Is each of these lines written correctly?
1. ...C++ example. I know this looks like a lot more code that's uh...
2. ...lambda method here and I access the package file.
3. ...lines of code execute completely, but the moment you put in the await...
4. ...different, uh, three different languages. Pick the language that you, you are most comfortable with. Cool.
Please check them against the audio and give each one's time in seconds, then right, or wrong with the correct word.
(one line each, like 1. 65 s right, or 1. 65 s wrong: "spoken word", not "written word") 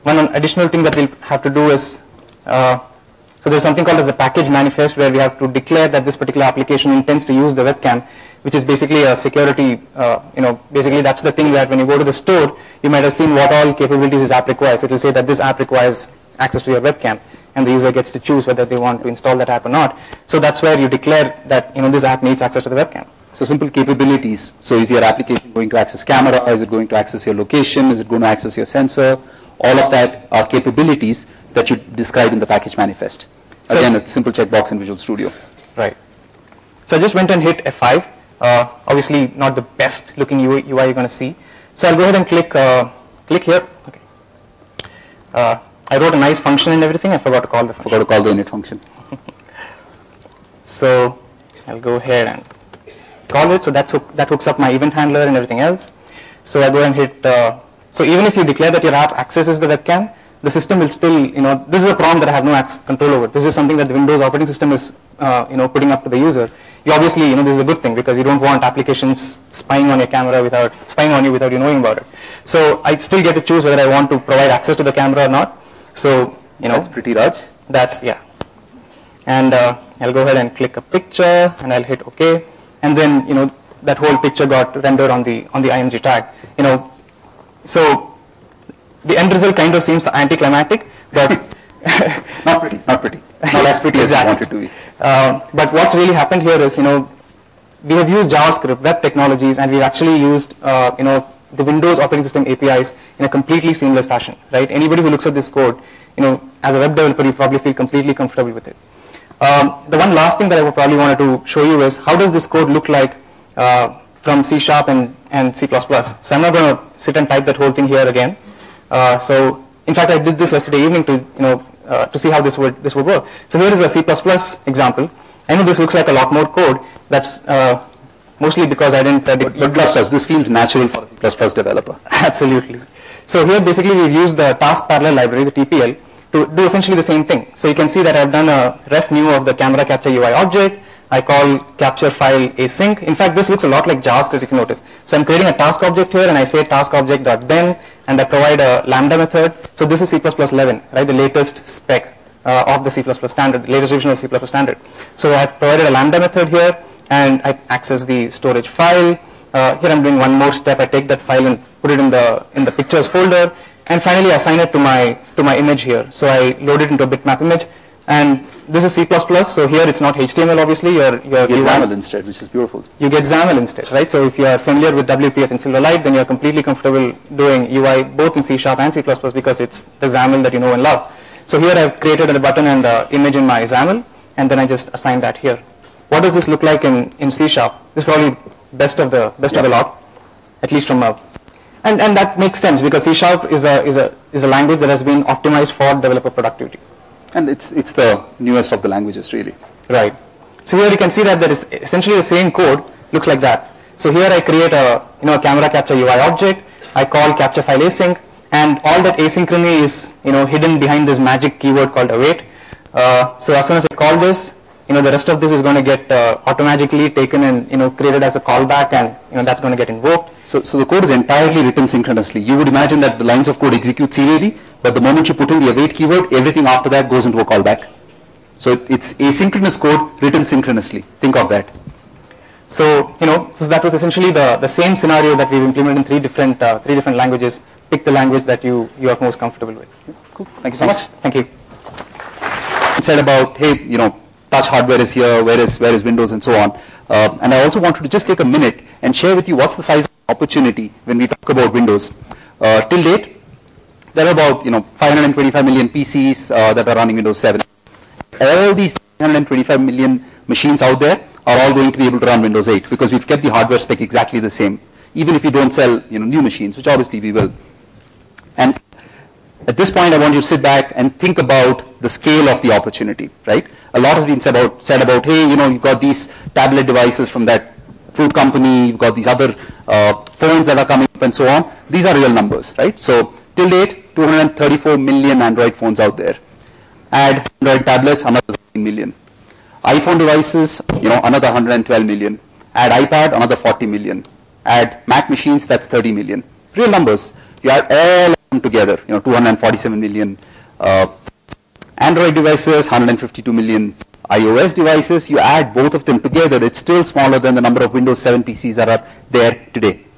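1. 123 s right
2. 155 s wrong: "storage", not "package"
3. 223 s wrong: "serially", not "completely"
4. 236 s right.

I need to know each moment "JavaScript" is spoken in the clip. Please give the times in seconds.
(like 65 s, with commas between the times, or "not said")
98 s, 143 s.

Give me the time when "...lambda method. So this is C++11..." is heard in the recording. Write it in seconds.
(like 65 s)
148 s.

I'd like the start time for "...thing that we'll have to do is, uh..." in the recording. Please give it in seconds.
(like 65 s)
0 s.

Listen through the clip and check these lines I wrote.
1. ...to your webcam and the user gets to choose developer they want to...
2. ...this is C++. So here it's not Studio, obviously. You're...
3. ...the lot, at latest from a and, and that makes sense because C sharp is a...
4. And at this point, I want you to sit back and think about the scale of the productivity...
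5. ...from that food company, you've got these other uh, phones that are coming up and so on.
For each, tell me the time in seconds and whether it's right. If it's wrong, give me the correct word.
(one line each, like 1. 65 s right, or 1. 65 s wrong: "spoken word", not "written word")
1. 16 s wrong: "whether", not "developer"
2. 168 s wrong: "HTML", not "Studio"
3. 189 s wrong: "least", not "latest"
4. 268 s wrong: "opportunity", not "productivity"
5. 277 s right.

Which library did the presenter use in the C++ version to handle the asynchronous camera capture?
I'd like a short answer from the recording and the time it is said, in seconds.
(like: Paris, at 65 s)
Task parallel library, at 134 s.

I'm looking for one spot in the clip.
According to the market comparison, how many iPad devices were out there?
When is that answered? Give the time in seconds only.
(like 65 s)
293 s.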